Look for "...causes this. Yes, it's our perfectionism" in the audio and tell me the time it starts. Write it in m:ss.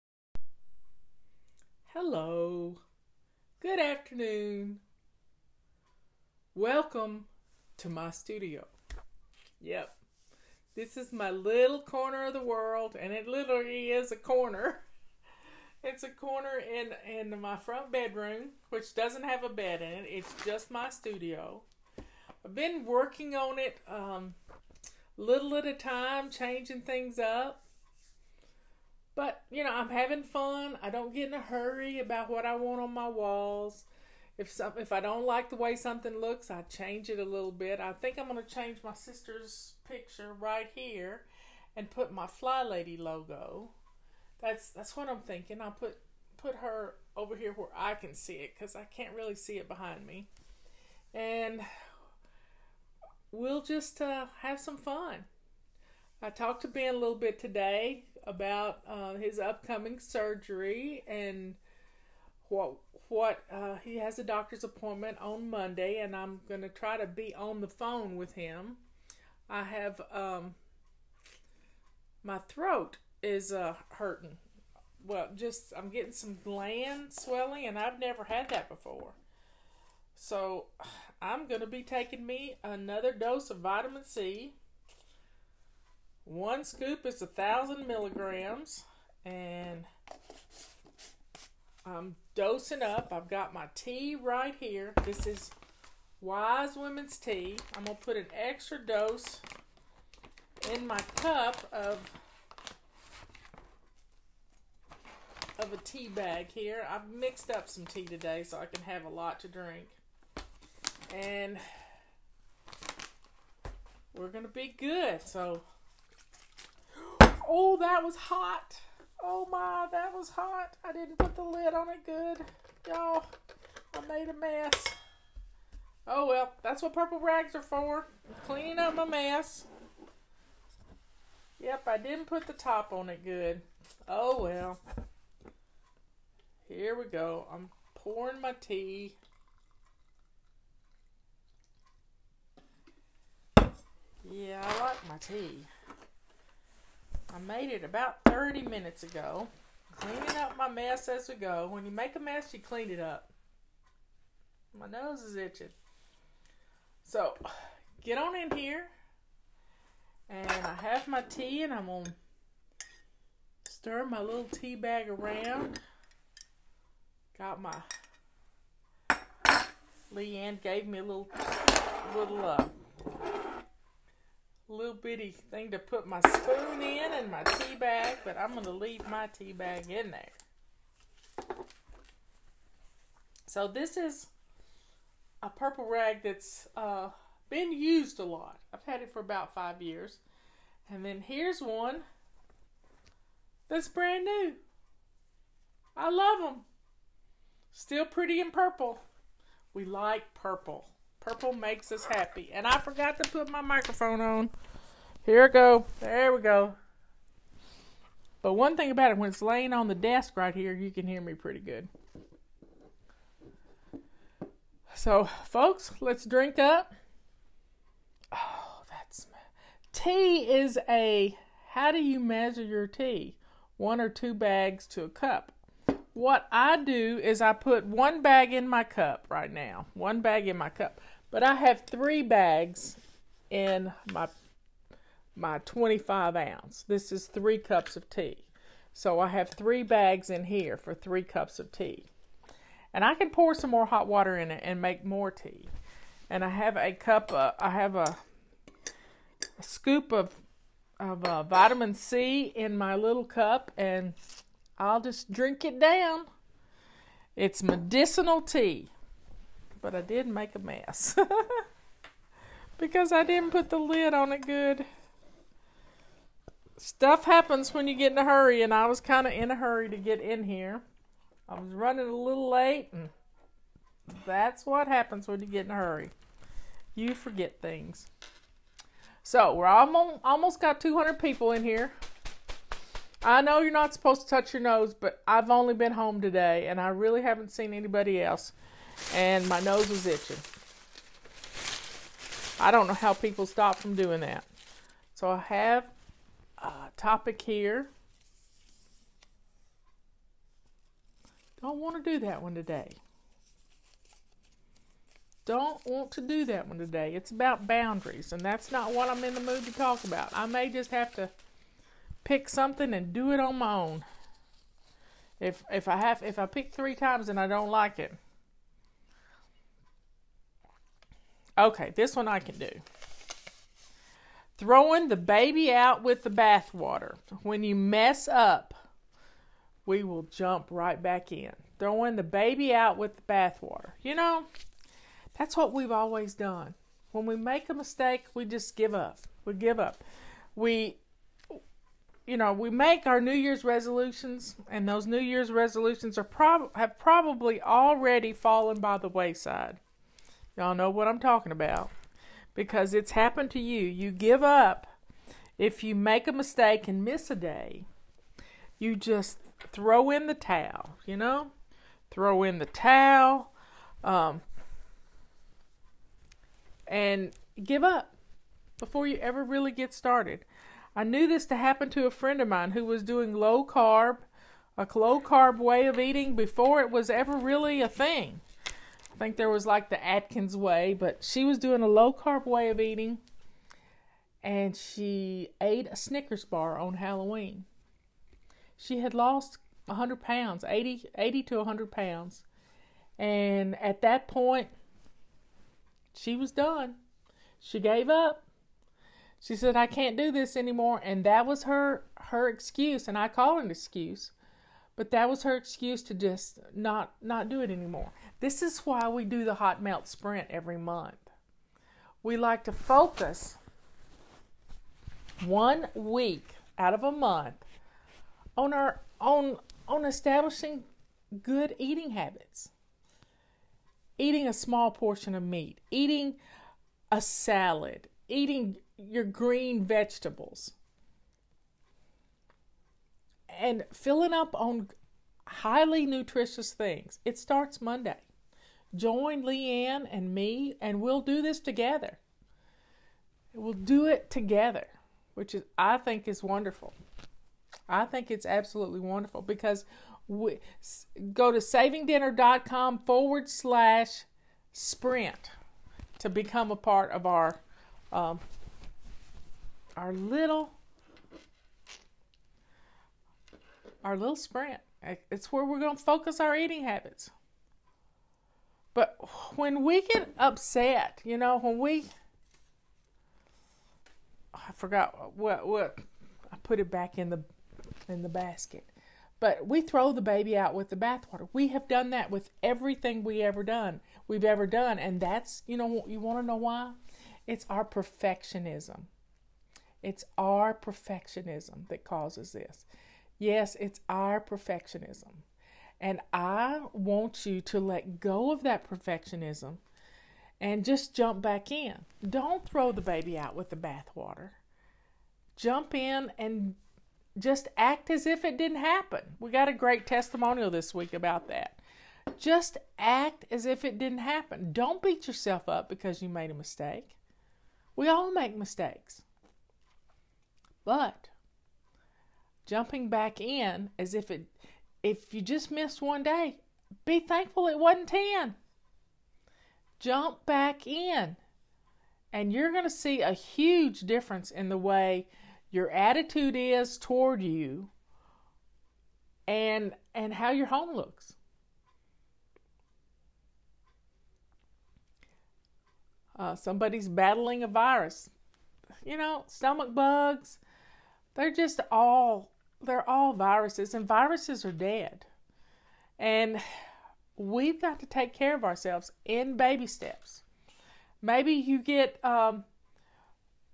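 8:12.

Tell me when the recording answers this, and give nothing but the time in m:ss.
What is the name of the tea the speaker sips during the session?
1:36.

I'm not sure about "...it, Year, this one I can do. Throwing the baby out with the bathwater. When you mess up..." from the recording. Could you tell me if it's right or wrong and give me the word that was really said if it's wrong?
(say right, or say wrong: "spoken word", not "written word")
wrong: "Okay", not "Year".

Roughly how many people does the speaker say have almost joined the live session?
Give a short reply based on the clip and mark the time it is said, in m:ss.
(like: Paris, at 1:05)
200, at 4:40.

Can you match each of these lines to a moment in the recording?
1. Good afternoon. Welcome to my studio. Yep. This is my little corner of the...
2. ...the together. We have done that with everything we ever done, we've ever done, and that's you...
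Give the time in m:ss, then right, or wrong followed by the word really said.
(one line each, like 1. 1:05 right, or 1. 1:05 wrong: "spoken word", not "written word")
1. 0:03 right
2. 8:00 wrong: "bathwater", not "together".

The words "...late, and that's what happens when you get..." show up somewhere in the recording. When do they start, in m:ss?
4:32.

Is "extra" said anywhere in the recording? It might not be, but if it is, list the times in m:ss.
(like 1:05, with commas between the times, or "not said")
1:38.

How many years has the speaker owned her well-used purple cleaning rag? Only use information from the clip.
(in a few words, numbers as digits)
5.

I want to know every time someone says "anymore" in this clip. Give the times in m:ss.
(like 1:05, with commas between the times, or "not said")
6:40, 6:47.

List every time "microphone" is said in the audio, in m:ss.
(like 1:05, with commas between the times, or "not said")
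3:23.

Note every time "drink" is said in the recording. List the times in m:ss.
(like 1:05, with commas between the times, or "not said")
1:49, 3:36, 4:15.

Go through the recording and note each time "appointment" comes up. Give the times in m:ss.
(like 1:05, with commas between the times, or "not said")
1:04.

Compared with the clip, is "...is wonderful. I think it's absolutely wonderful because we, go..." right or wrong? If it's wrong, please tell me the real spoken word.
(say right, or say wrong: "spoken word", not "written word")
right.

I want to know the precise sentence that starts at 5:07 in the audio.
It's about boundaries, and that's not what I'm in the mood to talk about.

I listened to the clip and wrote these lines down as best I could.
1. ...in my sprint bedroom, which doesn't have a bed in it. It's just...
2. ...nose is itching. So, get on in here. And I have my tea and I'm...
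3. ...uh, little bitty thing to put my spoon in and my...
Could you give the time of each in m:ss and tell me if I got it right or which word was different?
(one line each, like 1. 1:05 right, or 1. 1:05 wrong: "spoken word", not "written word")
1. 0:17 wrong: "front", not "sprint"
2. 2:34 right
3. 2:52 right.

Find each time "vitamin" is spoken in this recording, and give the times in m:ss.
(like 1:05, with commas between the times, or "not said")
1:23, 4:11.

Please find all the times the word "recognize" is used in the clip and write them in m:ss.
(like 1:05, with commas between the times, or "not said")
not said.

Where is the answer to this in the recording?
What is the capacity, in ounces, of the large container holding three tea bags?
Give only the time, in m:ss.
3:55.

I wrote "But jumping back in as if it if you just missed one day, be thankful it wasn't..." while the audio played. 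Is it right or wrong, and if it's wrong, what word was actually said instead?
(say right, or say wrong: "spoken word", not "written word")
right.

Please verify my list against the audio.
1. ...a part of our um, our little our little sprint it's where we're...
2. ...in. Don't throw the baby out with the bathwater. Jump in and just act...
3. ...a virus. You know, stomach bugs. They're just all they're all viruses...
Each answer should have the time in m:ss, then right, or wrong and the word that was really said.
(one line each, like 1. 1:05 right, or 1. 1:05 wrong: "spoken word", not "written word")
1. 7:36 right
2. 8:21 right
3. 9:07 right.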